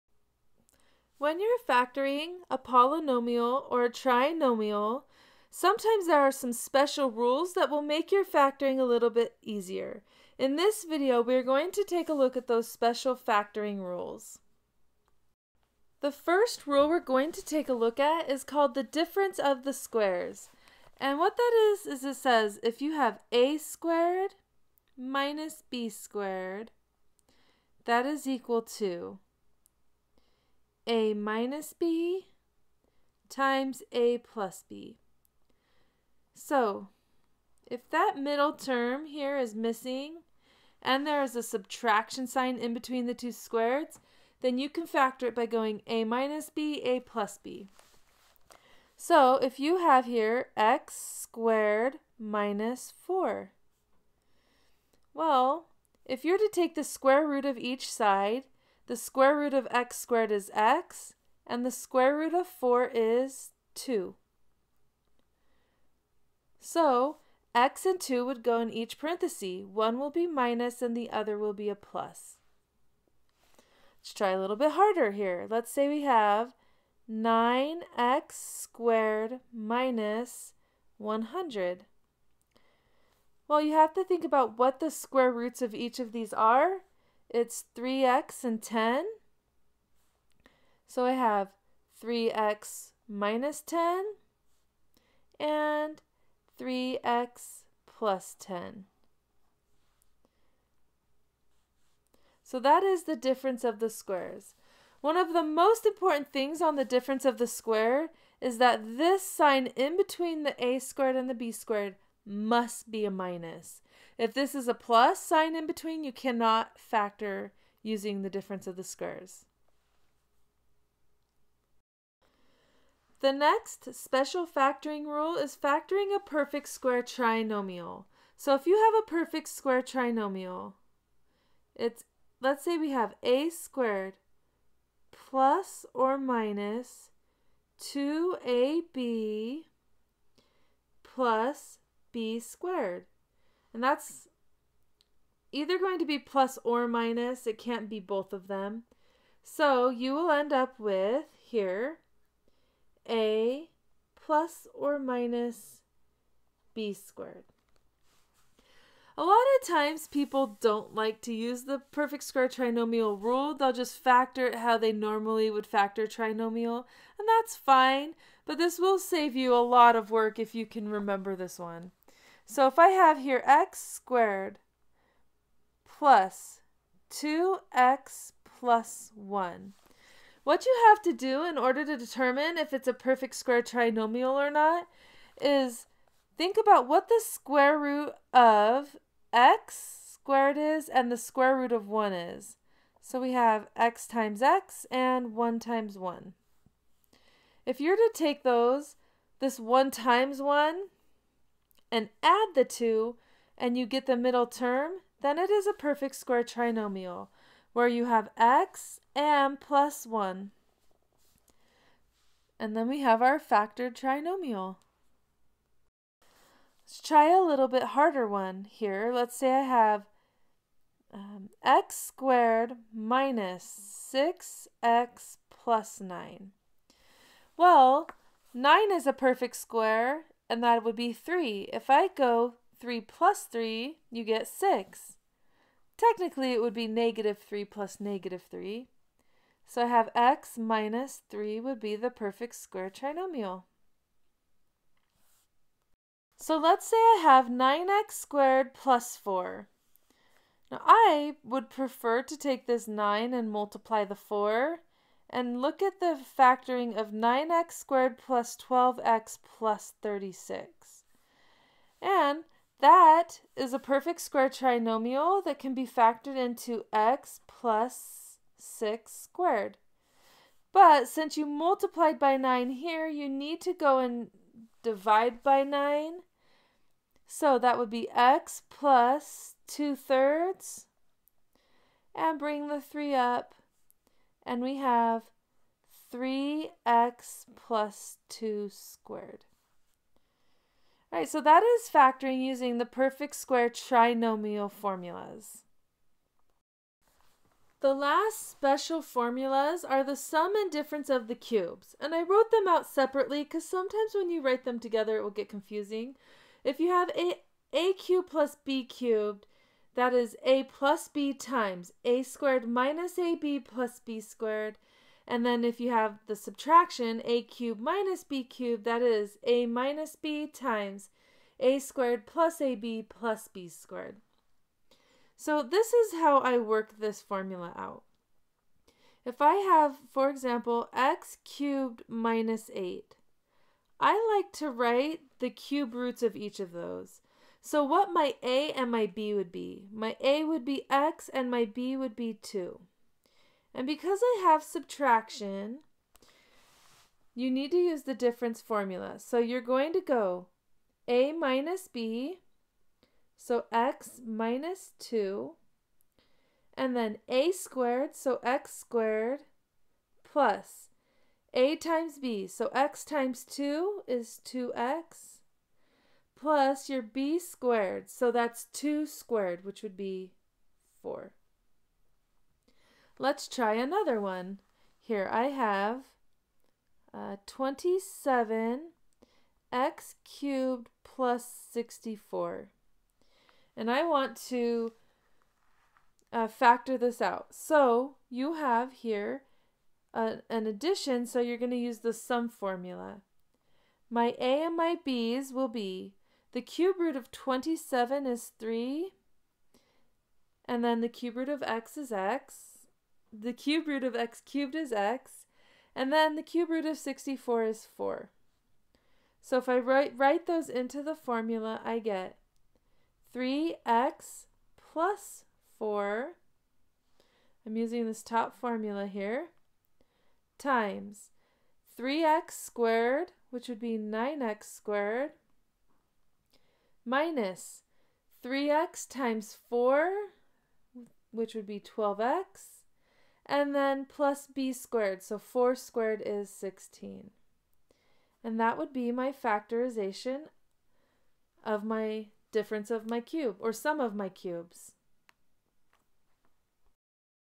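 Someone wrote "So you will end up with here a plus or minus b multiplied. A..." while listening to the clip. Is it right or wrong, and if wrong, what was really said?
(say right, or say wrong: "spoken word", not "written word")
wrong: "squared", not "multiplied".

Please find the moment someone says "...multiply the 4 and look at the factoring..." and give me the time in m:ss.
4:13.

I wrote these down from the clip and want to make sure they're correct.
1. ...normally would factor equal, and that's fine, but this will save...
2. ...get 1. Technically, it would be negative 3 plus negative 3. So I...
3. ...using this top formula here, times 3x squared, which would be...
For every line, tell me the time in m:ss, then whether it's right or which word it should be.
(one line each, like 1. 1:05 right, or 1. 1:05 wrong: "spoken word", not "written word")
1. 2:44 wrong: "trinomial", not "equal"
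2. 3:54 wrong: "6", not "1"
3. 6:57 right.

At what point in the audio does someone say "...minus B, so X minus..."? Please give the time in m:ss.
5:51.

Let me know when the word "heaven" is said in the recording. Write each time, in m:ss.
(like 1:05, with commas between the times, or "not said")
not said.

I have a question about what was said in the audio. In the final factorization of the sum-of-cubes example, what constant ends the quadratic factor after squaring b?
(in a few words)
16.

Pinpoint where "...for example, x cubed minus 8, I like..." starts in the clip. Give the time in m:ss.
5:30.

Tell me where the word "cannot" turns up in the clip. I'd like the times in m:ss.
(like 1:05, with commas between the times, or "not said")
1:56.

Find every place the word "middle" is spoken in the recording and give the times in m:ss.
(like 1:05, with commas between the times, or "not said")
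0:38, 3:24.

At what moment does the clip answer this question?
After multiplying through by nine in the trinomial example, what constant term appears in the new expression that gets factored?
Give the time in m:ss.
4:20.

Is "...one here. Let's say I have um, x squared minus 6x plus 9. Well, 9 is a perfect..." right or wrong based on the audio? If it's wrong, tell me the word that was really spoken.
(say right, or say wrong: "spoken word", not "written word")
right.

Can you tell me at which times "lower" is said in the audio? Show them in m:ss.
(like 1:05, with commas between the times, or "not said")
not said.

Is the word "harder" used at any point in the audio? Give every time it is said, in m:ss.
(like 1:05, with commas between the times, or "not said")
1:14, 3:37.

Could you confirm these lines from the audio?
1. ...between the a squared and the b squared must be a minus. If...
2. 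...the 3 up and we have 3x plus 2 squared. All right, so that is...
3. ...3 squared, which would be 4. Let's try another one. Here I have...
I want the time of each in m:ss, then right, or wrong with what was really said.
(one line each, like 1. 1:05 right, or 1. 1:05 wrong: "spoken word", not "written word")
1. 1:49 right
2. 4:42 right
3. 6:08 wrong: "2", not "3".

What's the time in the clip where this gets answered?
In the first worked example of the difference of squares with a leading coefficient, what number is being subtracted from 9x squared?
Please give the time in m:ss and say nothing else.
1:20.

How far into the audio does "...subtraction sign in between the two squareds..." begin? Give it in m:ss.
0:41.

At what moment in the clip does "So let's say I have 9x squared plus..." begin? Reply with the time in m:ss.
4:06.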